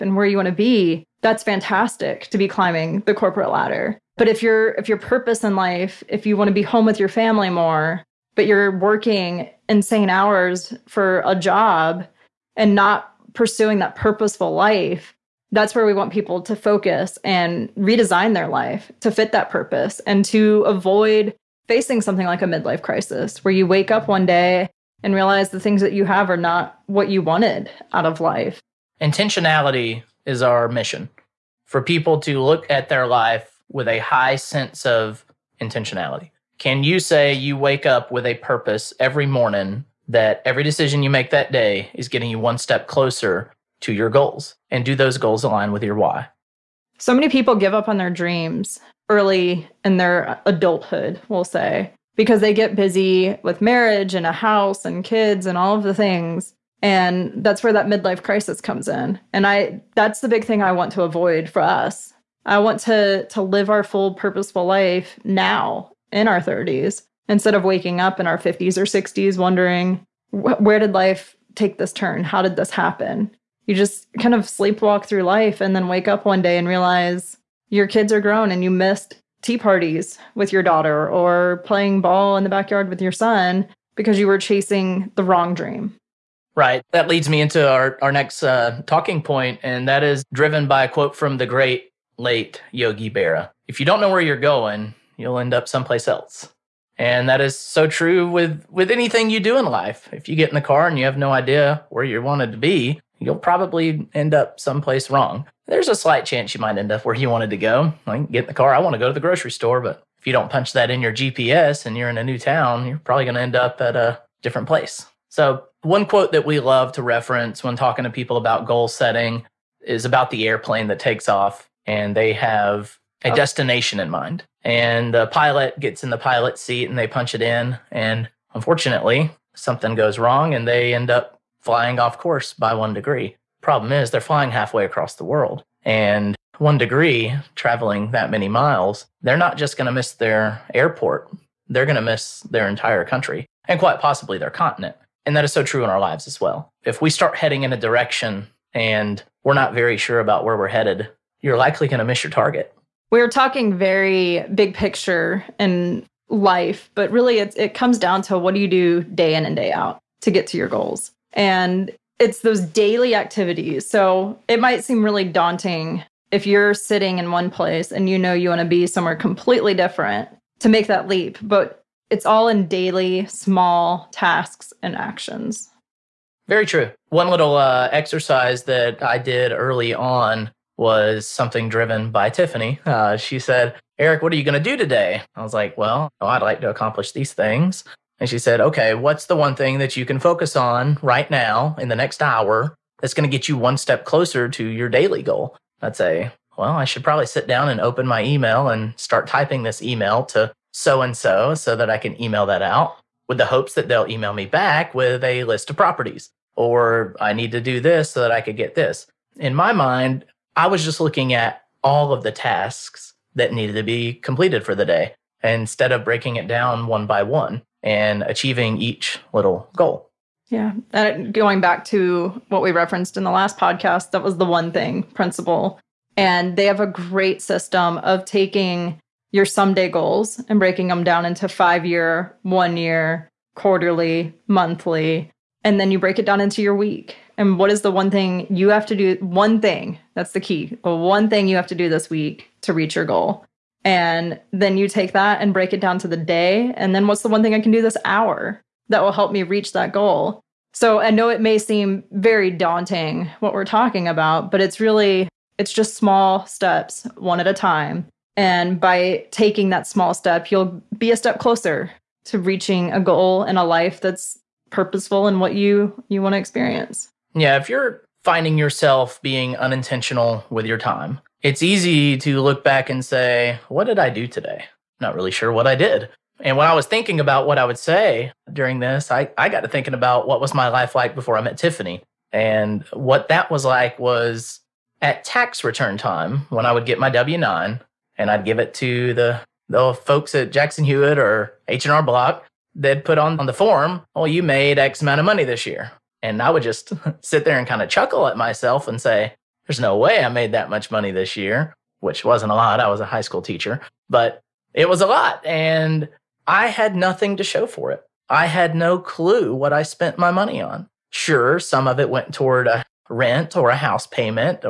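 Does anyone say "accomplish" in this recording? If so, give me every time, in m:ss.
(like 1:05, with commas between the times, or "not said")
3:06.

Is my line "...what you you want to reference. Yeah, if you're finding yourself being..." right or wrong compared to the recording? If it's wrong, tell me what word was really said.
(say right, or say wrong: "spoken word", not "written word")
wrong: "experience", not "reference".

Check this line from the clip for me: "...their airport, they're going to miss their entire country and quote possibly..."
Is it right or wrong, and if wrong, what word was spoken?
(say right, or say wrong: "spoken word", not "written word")
wrong: "quite", not "quote".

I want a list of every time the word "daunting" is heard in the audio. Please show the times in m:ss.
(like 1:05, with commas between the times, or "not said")
2:45, 4:12.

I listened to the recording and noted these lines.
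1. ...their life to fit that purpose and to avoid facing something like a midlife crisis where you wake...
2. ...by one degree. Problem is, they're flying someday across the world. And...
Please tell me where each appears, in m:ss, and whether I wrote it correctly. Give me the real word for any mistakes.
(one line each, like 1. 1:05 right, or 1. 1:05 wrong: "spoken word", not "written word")
1. 0:18 right
2. 2:12 wrong: "halfway", not "someday".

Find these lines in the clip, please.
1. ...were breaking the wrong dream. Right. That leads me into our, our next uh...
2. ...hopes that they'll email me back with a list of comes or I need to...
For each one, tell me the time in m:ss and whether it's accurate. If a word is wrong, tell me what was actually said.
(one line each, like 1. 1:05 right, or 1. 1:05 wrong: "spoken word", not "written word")
1. 1:24 wrong: "chasing", not "breaking"
2. 3:23 wrong: "properties", not "comes".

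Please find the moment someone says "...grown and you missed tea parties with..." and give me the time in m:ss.
1:18.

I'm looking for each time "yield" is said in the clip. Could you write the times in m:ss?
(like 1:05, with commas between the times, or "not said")
not said.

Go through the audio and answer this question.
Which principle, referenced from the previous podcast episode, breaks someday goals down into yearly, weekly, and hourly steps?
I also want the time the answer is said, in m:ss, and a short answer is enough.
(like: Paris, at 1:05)
the one thing principle, at 3:44.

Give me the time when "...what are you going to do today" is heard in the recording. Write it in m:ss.
3:04.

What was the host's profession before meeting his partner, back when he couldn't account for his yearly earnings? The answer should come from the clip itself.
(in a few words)
high school teacher.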